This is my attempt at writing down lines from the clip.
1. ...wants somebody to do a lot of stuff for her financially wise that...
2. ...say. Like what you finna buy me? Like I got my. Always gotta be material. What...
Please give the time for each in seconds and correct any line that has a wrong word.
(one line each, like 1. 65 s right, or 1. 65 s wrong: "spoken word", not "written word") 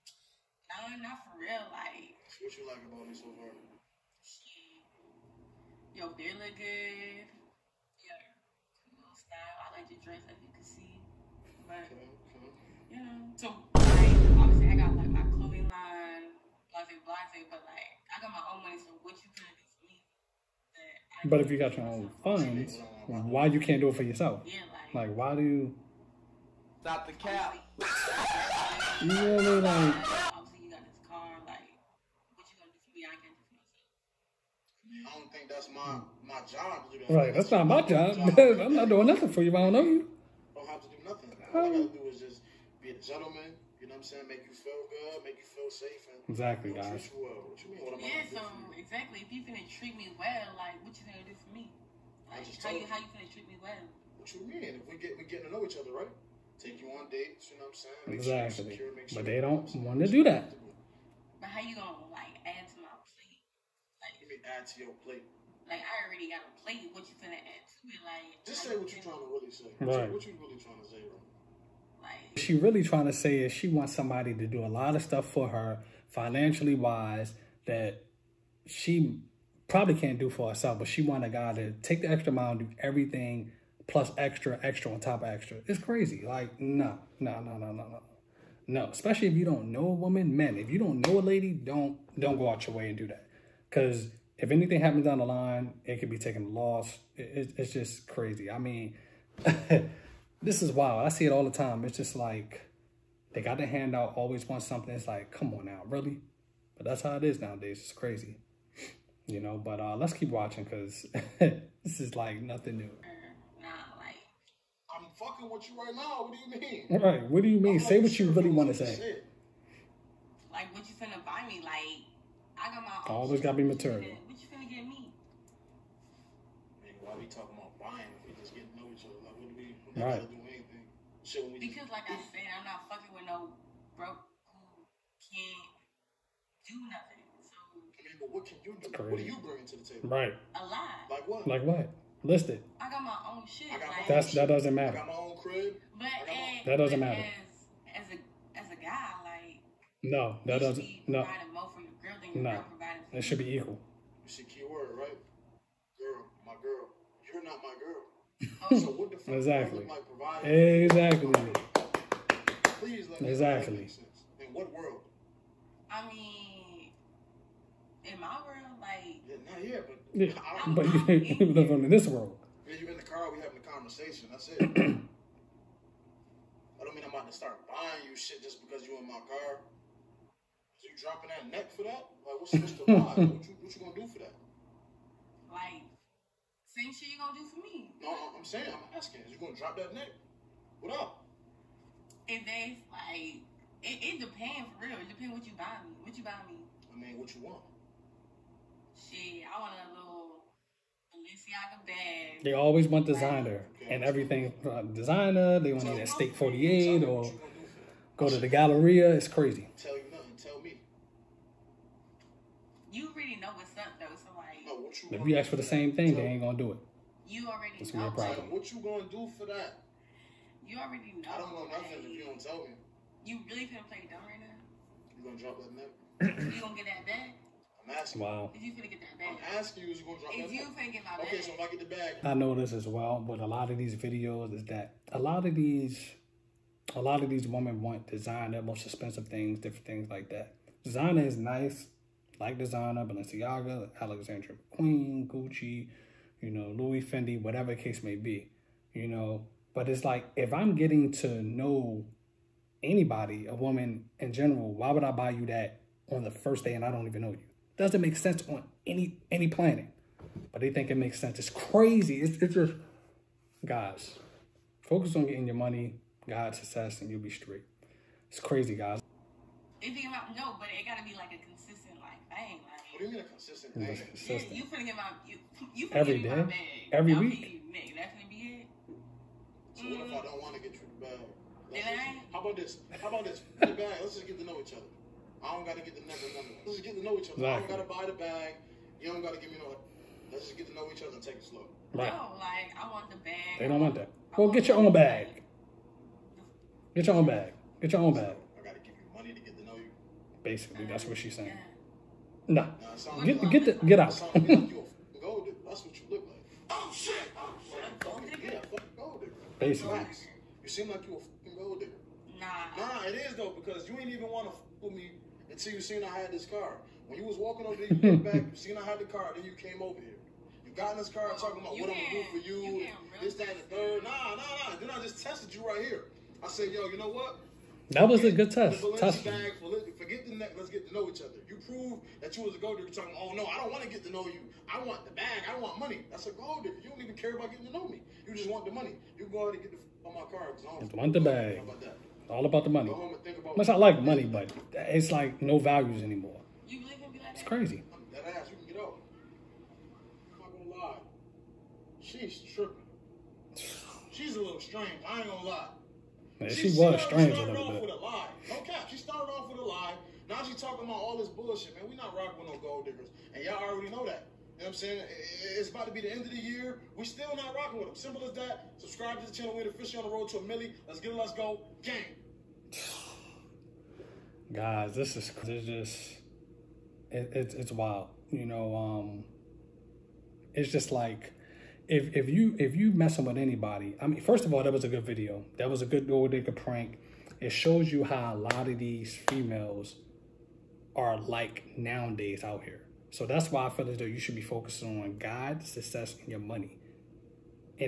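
1. 73 s right
2. 118 s right.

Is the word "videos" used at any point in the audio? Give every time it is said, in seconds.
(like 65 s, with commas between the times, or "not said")
233 s, 385 s.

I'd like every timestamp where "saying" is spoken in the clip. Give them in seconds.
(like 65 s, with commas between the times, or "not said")
44 s, 58 s, 188 s, 301 s, 364 s.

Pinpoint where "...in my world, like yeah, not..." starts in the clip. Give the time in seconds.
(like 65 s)
168 s.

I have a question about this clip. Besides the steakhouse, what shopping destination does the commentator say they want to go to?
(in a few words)
The Galleria.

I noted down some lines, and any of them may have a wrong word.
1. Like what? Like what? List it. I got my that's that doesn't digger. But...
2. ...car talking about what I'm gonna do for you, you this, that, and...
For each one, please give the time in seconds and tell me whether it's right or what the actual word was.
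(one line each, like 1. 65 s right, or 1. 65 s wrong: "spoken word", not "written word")
1. 141 s wrong: "matter", not "digger"
2. 321 s right.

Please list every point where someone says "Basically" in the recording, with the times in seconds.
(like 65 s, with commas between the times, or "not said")
300 s, 309 s.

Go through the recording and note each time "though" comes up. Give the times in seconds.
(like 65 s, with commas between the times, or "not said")
213 s, 313 s, 393 s.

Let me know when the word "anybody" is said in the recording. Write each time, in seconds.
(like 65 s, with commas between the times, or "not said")
252 s, 383 s.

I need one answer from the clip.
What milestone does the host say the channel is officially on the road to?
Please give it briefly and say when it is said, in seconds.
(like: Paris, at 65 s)
A milli, at 370 s.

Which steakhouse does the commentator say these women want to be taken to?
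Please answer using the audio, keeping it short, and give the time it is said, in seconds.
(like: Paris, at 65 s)
Steak 48, at 206 s.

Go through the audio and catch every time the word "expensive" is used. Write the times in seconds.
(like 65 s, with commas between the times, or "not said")
238 s.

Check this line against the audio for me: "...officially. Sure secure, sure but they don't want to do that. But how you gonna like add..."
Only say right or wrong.
wrong.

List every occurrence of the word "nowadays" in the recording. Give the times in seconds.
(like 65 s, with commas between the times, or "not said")
107 s, 391 s.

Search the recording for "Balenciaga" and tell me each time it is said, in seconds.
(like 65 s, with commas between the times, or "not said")
201 s, 243 s.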